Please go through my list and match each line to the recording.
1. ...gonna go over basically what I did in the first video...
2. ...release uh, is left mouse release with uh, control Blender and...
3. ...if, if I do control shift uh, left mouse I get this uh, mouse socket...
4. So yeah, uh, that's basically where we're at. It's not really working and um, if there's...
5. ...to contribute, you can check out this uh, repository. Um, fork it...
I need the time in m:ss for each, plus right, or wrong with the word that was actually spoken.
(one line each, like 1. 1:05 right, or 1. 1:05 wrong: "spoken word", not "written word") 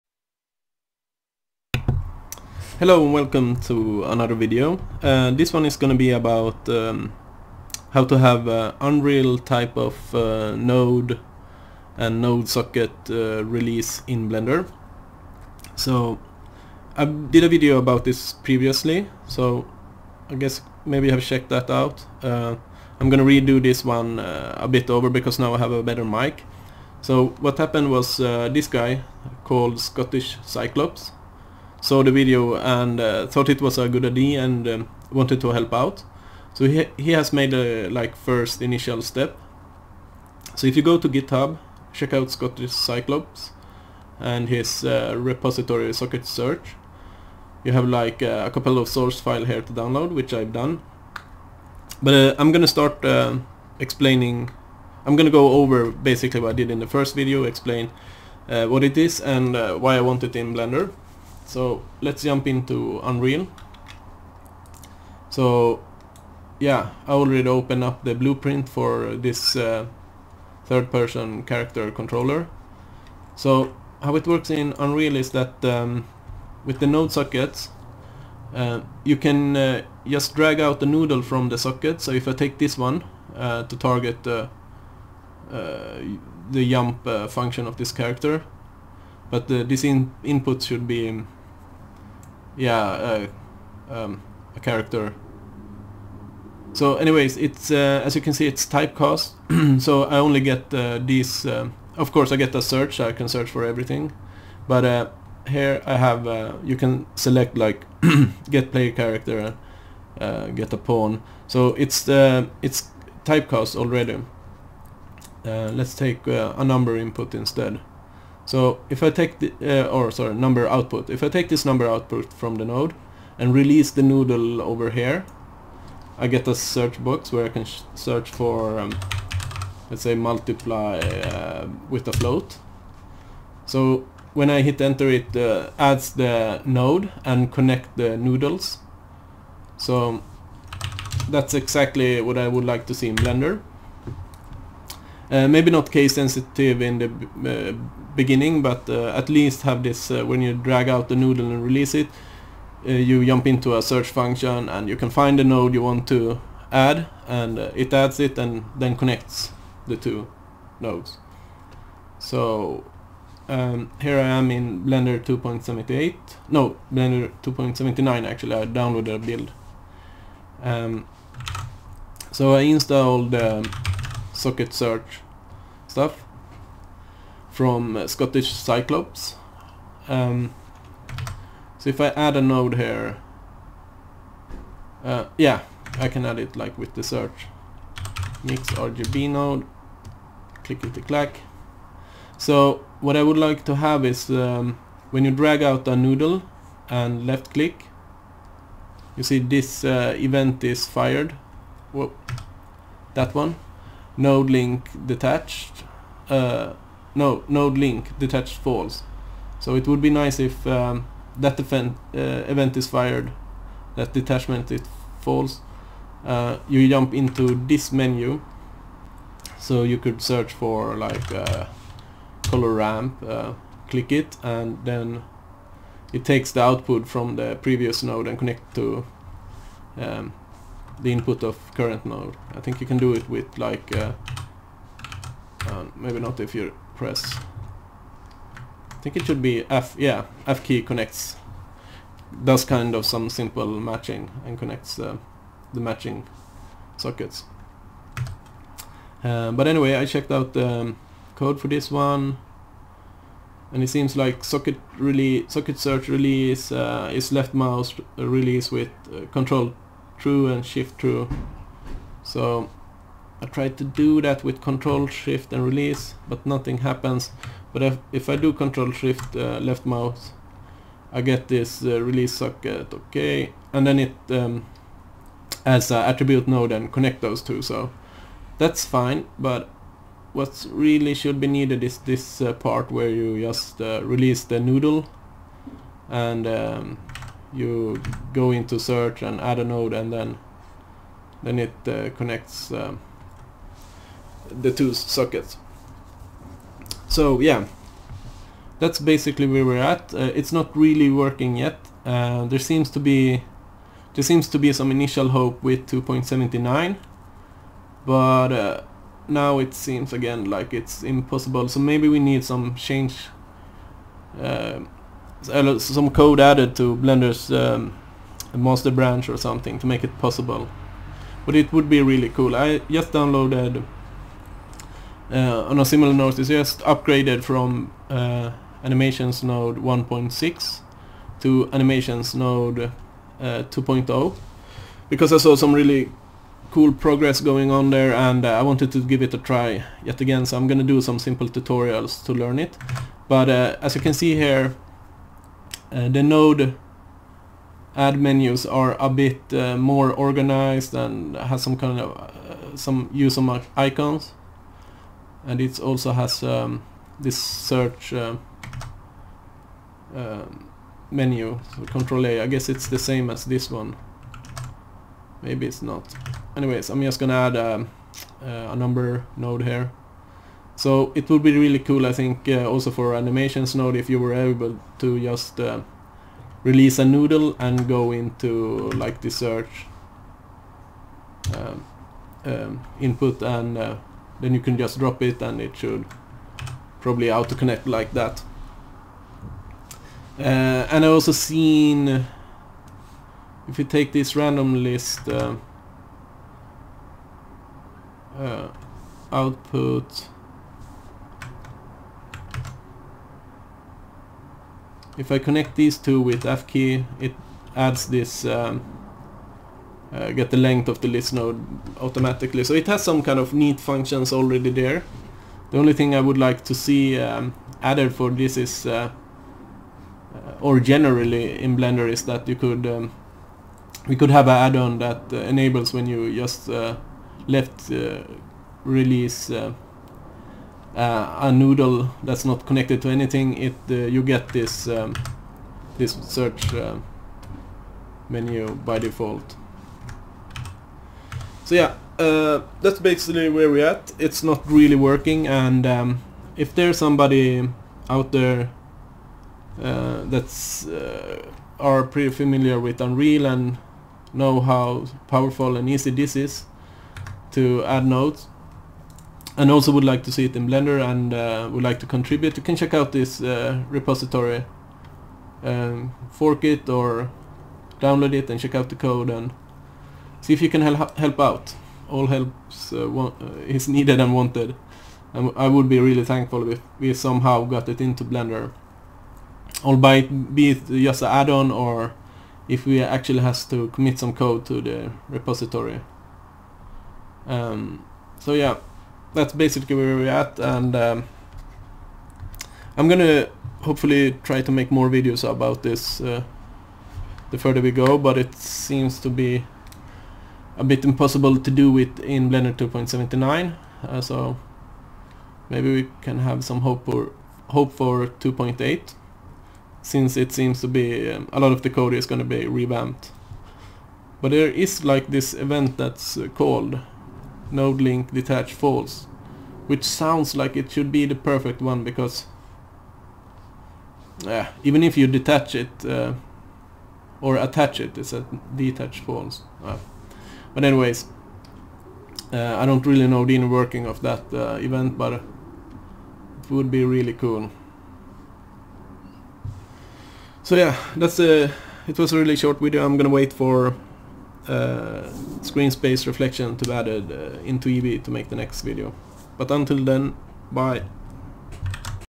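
1. 0:55 right
2. 4:16 wrong: "True", not "Blender"
3. 4:27 wrong: "release", not "mouse"
4. 7:21 right
5. 7:41 right.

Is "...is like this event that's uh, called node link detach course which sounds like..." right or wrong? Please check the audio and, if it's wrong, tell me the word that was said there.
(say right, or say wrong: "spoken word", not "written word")
wrong: "false", not "course".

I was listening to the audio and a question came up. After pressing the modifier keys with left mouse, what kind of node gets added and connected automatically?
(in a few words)
attribute node.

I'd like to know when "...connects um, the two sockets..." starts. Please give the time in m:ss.
4:52.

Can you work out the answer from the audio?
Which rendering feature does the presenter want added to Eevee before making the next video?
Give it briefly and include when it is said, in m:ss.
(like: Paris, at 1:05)
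screen space reflection, at 9:05.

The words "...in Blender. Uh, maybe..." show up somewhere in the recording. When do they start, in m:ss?
2:23.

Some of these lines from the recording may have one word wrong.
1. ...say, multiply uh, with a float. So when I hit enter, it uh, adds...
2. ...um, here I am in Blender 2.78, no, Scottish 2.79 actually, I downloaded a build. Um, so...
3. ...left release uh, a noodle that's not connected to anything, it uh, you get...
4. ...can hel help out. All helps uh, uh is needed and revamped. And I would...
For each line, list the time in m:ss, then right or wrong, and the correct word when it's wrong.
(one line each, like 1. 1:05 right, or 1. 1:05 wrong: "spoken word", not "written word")
1. 2:10 right
2. 2:43 wrong: "Blender", not "Scottish"
3. 7:07 right
4. 7:50 wrong: "wanted", not "revamped".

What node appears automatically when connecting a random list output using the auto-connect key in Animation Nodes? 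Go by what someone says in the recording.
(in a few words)
get the length of the list.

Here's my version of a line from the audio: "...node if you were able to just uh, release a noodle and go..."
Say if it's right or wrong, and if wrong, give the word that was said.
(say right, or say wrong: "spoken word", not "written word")
right.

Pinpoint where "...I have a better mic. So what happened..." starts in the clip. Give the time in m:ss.
0:25.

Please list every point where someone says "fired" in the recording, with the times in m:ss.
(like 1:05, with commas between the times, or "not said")
3:20, 3:32.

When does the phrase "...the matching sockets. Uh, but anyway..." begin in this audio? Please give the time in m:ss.
4:05.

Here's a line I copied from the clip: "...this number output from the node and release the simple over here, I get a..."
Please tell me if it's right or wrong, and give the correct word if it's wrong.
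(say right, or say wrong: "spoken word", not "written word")
wrong: "noodle", not "simple".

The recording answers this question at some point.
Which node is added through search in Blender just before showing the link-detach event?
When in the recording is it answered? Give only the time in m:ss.
3:08.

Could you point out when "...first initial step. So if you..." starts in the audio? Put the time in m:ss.
0:38.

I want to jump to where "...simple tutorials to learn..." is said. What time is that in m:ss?
5:41.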